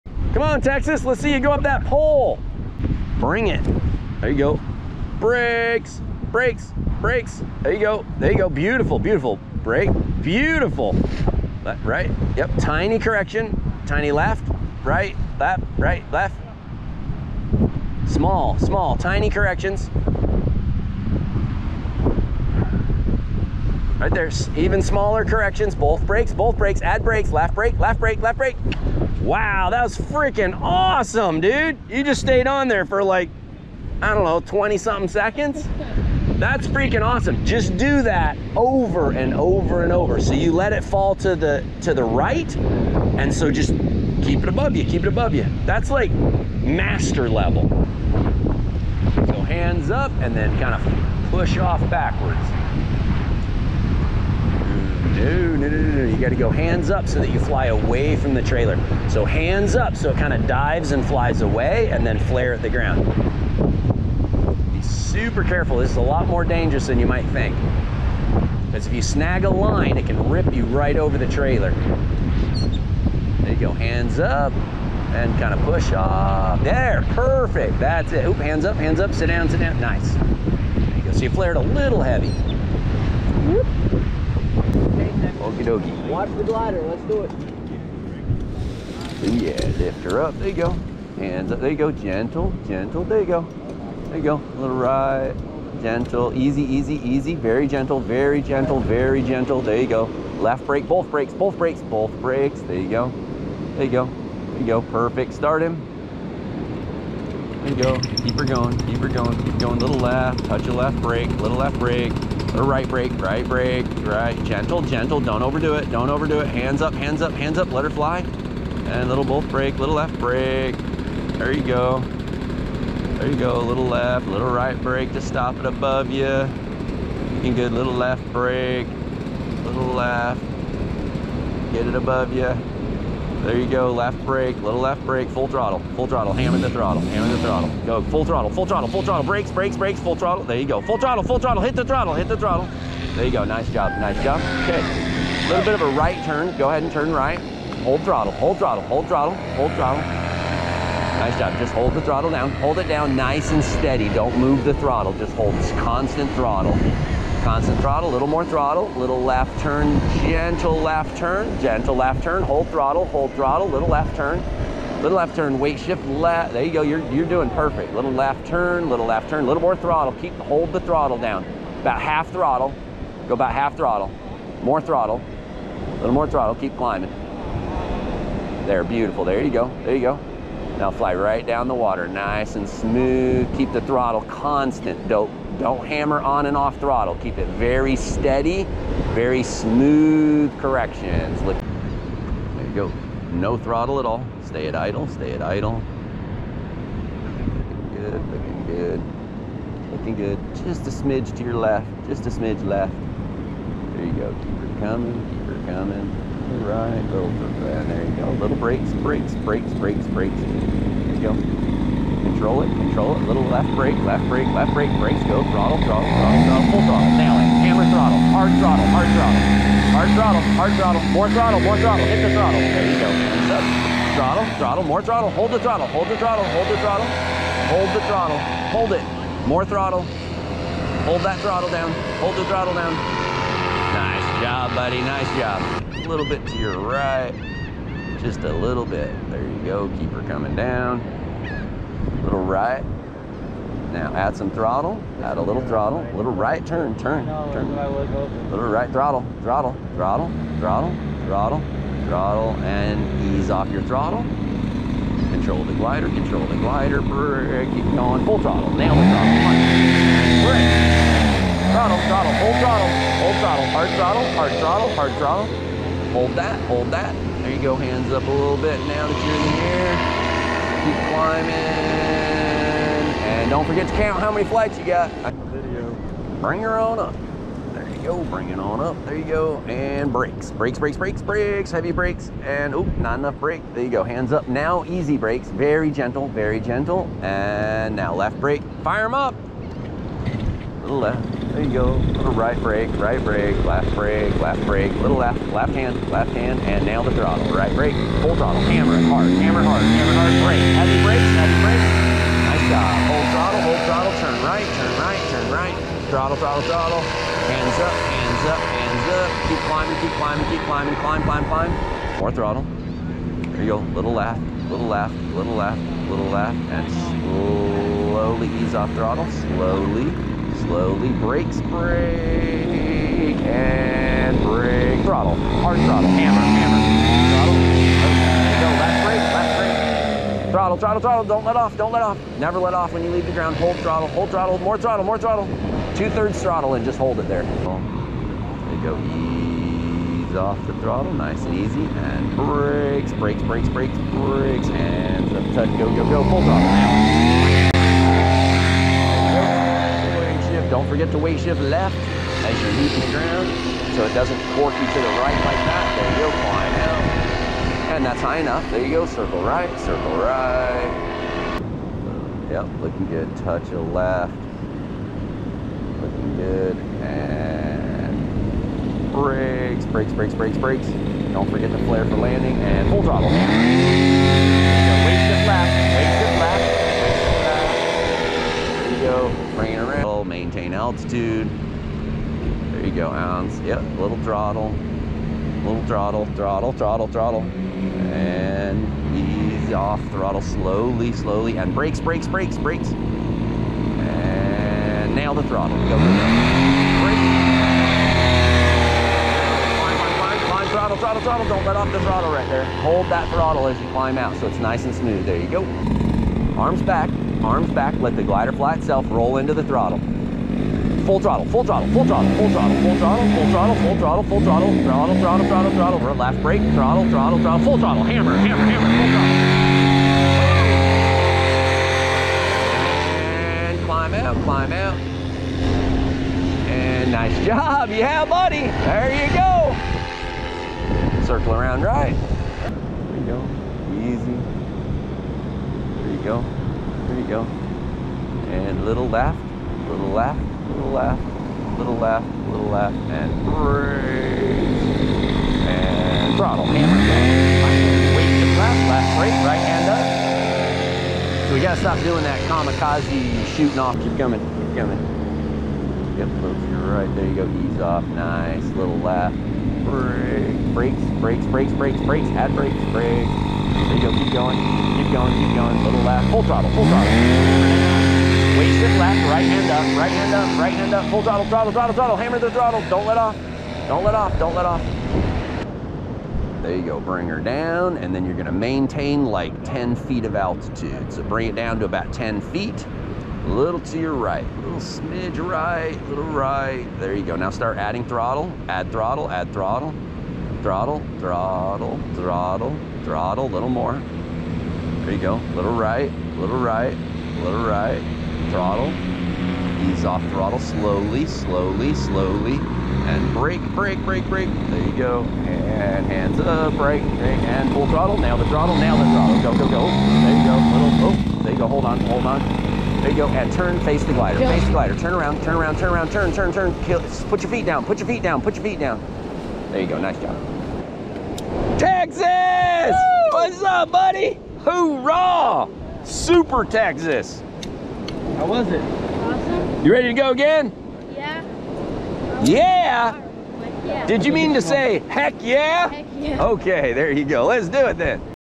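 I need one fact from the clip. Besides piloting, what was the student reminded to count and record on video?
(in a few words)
how many flights.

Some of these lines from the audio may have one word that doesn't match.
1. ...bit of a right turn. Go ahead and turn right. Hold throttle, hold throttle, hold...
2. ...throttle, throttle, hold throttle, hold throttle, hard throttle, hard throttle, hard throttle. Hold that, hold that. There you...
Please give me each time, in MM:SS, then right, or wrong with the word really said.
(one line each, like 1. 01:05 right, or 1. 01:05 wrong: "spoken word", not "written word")
1. 02:25 right
2. 04:21 right.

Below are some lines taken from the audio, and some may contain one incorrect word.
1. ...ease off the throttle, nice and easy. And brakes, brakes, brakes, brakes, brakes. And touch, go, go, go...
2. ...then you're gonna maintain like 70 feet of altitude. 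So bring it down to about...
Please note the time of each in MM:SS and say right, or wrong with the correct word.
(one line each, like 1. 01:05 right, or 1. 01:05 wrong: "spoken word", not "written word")
1. 05:40 right
2. 07:58 wrong: "10", not "70".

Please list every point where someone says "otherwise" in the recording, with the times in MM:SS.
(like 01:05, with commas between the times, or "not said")
not said.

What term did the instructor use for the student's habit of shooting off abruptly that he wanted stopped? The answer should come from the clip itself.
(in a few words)
kamikaze.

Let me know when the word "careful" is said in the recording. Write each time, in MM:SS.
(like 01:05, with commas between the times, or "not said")
01:05.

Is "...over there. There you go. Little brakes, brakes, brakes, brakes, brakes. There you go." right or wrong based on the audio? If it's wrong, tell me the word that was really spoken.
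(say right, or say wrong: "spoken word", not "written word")
right.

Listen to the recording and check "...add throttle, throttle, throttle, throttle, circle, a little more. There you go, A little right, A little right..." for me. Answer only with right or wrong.
wrong.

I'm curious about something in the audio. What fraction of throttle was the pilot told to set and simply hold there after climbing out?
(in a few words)
Two-thirds.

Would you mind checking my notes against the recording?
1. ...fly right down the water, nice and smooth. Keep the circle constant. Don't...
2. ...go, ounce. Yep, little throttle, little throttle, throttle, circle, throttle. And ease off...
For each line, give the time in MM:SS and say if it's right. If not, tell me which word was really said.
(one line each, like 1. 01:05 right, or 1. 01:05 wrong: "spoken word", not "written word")
1. 03:00 wrong: "throttle", not "circle"
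2. 06:22 wrong: "throttle", not "circle".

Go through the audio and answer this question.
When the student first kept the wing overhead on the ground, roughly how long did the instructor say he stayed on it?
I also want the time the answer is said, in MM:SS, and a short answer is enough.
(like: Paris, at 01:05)
20 something seconds, at 00:34.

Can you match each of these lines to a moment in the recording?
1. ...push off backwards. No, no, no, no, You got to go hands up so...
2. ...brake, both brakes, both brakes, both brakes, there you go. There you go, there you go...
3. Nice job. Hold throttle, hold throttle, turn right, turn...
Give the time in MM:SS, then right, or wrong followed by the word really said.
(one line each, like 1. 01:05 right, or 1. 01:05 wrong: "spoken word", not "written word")
1. 00:51 right
2. 01:40 right
3. 05:02 right.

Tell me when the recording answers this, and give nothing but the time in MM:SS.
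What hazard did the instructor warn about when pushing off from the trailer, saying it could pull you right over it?
01:09.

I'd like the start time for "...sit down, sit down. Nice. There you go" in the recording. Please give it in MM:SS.
01:19.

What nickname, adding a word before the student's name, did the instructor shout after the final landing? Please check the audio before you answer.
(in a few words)
Super Texas.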